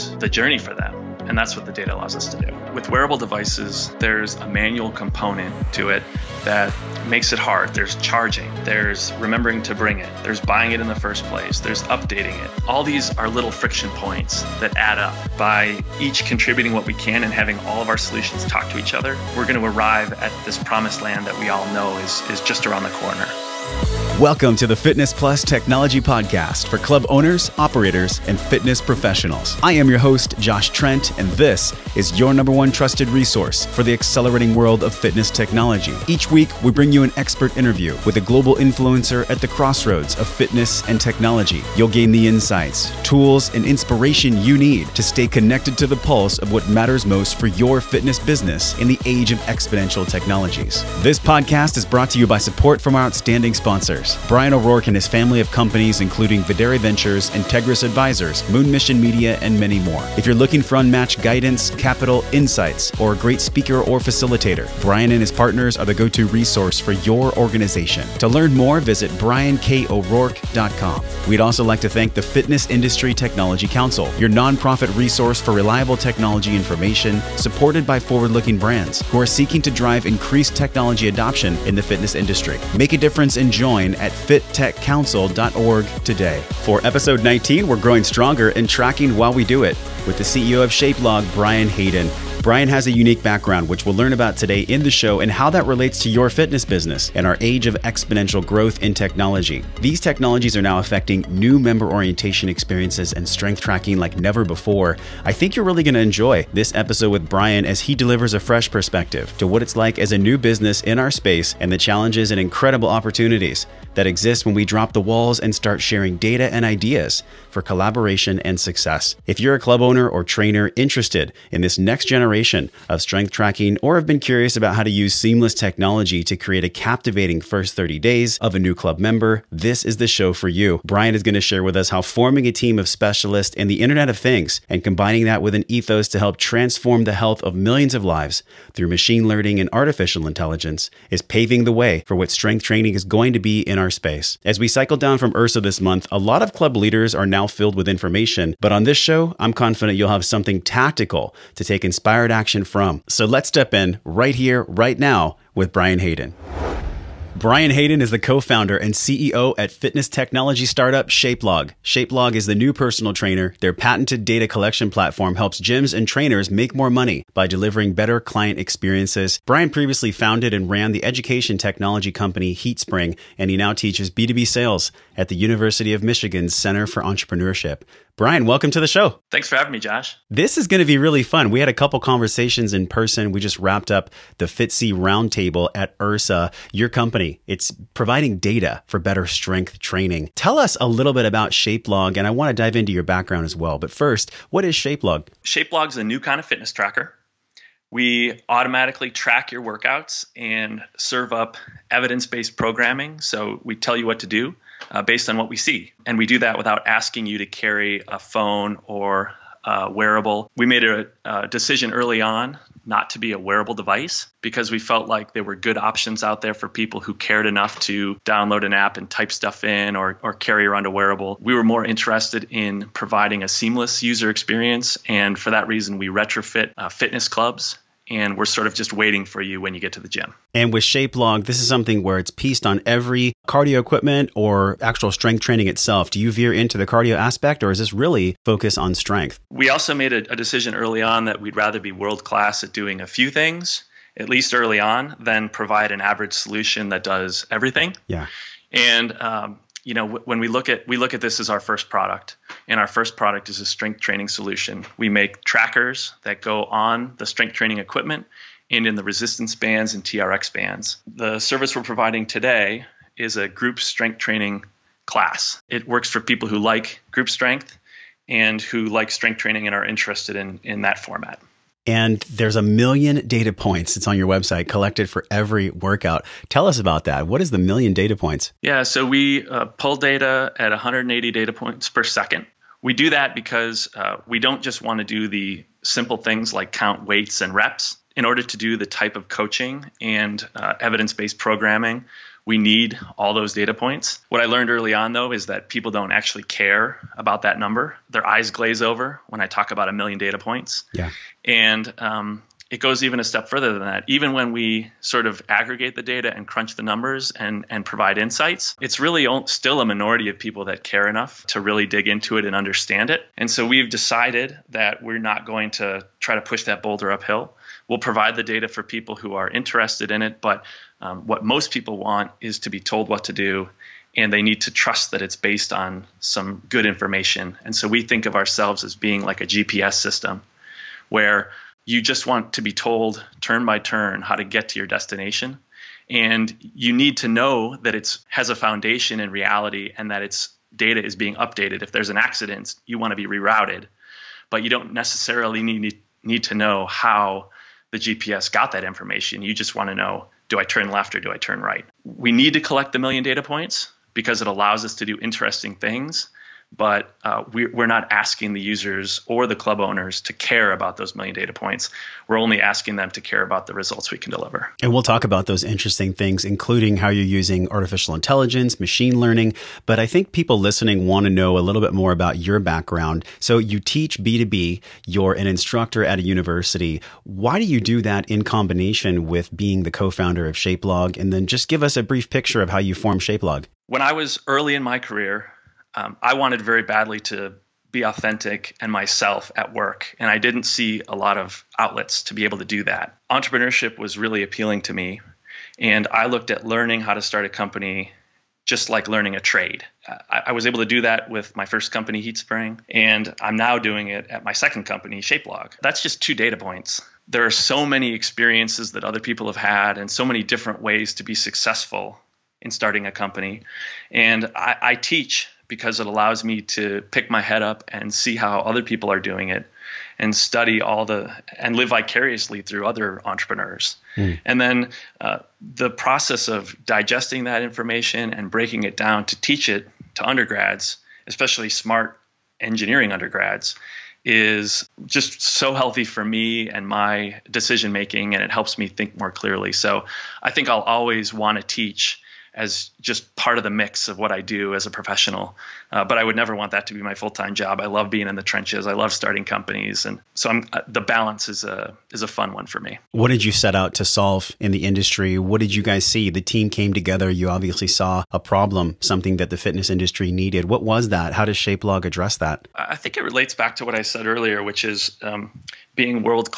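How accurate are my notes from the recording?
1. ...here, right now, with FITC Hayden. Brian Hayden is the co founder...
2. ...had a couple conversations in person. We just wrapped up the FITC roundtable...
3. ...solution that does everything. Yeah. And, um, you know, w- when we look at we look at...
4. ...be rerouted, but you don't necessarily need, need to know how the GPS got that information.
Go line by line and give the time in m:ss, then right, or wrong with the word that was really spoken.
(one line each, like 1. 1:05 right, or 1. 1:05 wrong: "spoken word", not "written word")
1. 2:34 wrong: "Brian", not "FITC"
2. 3:01 right
3. 4:06 right
4. 5:43 right.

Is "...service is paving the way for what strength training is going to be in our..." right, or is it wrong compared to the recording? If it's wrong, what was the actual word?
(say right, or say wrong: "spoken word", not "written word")
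wrong: "intelligence", not "service".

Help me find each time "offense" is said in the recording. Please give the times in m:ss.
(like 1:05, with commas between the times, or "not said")
not said.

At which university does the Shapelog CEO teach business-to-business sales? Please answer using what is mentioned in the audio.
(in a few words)
University of Michigan.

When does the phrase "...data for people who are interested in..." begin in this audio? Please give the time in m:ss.
5:18.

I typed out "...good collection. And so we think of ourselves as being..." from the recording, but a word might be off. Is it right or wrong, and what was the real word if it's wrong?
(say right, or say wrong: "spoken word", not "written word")
wrong: "information", not "collection".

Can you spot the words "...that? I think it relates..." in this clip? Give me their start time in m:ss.
7:42.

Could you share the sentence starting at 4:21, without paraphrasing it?
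The service we're providing today is a group strength training class.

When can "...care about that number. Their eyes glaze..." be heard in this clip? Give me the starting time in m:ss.
4:56.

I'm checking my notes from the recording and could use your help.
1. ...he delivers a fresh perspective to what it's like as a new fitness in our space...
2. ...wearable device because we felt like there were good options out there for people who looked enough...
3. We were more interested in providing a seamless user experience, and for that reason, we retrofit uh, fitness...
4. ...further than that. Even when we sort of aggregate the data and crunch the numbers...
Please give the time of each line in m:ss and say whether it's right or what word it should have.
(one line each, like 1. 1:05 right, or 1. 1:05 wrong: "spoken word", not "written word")
1. 1:47 wrong: "business", not "fitness"
2. 3:33 wrong: "cared", not "looked"
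3. 3:41 right
4. 5:03 right.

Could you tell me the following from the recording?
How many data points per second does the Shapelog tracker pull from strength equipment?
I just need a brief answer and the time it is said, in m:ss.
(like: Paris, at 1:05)
180, at 4:40.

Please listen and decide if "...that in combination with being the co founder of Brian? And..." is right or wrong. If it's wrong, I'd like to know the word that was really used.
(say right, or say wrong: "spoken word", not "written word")
wrong: "Shapelog", not "Brian".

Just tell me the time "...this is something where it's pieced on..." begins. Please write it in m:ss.
3:51.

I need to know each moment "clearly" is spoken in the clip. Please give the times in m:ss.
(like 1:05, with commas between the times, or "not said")
7:19.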